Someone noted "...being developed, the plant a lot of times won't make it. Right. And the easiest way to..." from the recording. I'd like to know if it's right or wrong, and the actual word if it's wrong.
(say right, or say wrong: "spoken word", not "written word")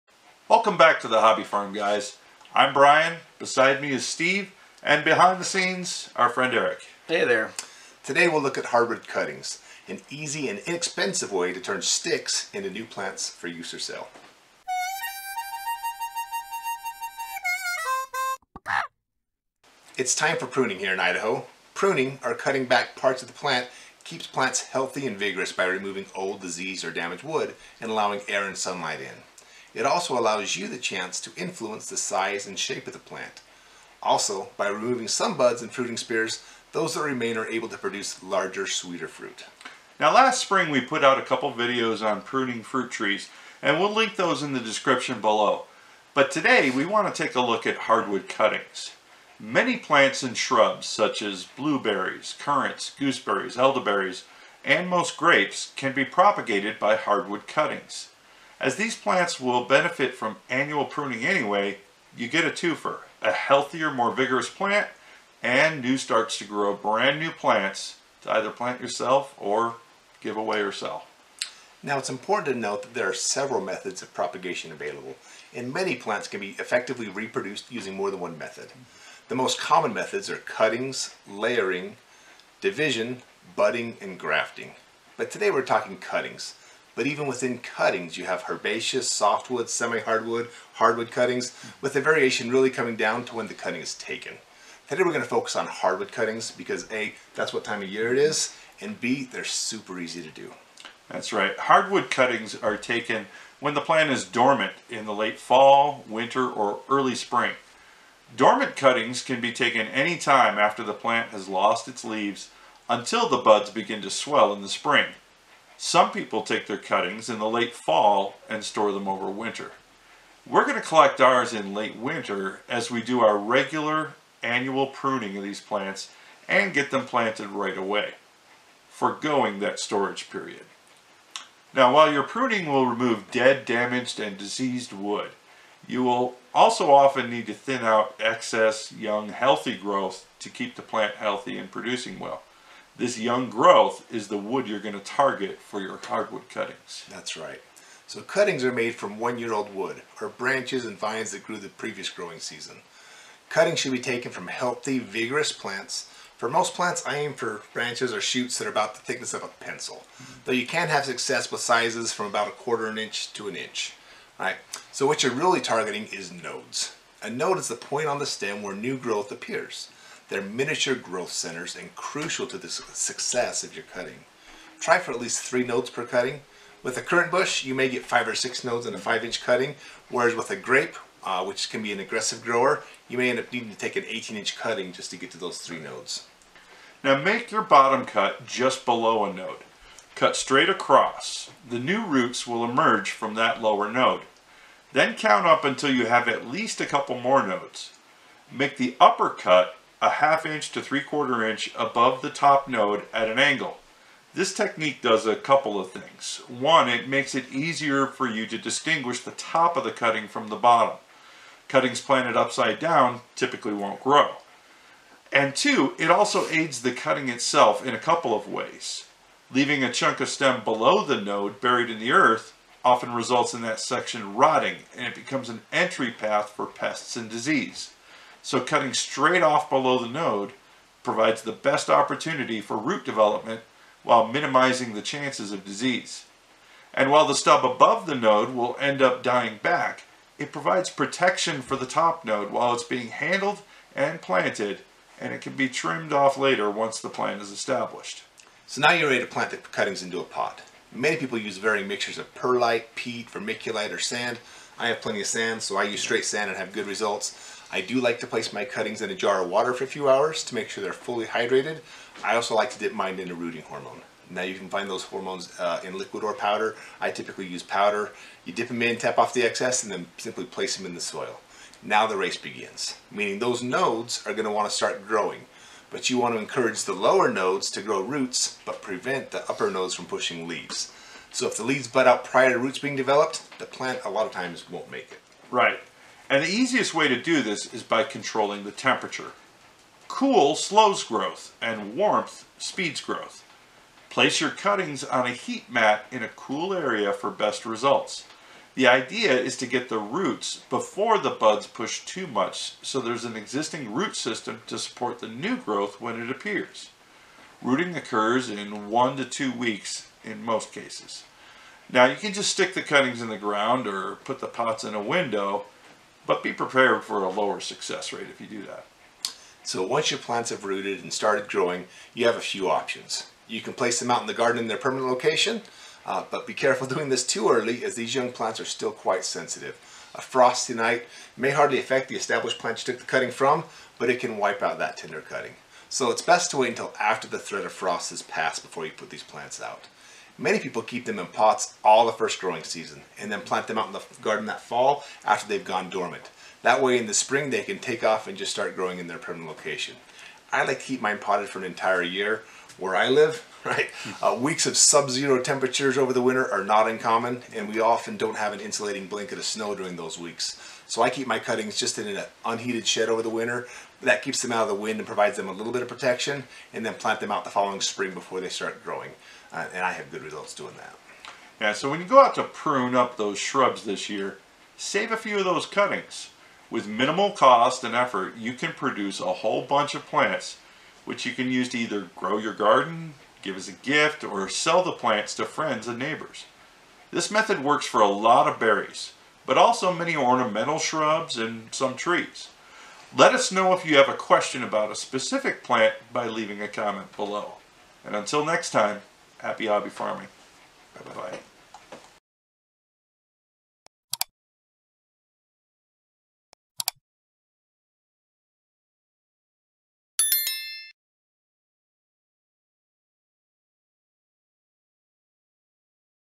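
right.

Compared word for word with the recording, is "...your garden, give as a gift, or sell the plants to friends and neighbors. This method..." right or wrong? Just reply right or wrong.
right.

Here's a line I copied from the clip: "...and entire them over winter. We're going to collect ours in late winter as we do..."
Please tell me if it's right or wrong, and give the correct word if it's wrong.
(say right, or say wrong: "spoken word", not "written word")
wrong: "store", not "entire".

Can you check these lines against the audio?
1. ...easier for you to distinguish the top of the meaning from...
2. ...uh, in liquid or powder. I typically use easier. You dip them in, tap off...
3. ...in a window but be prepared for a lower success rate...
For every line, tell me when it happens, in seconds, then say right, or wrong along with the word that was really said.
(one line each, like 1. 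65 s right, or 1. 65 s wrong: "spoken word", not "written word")
1. 207 s wrong: "cutting", not "meaning"
2. 265 s wrong: "powder", not "easier"
3. 314 s right.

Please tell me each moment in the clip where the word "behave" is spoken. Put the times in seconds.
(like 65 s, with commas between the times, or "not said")
not said.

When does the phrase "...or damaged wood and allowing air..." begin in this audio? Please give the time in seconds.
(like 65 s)
26 s.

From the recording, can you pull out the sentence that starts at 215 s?
And two, it also aids the cutting itself in a couple of ways.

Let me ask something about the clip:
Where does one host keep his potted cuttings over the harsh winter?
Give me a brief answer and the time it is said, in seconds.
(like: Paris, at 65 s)
an unheated shed, at 362 s.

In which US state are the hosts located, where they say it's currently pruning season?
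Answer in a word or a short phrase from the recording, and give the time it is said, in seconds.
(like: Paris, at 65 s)
Idaho, at 20 s.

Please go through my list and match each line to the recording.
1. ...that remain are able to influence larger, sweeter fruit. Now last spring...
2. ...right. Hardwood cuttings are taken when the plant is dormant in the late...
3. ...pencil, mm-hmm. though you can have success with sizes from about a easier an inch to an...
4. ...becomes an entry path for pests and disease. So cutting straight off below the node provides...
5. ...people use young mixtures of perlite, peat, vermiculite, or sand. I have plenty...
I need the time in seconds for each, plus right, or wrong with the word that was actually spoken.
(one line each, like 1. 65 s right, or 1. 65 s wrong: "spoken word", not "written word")
1. 36 s wrong: "produce", not "influence"
2. 101 s right
3. 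159 s wrong: "quarter", not "easier"
4. 225 s right
5. 251 s wrong: "varying", not "young".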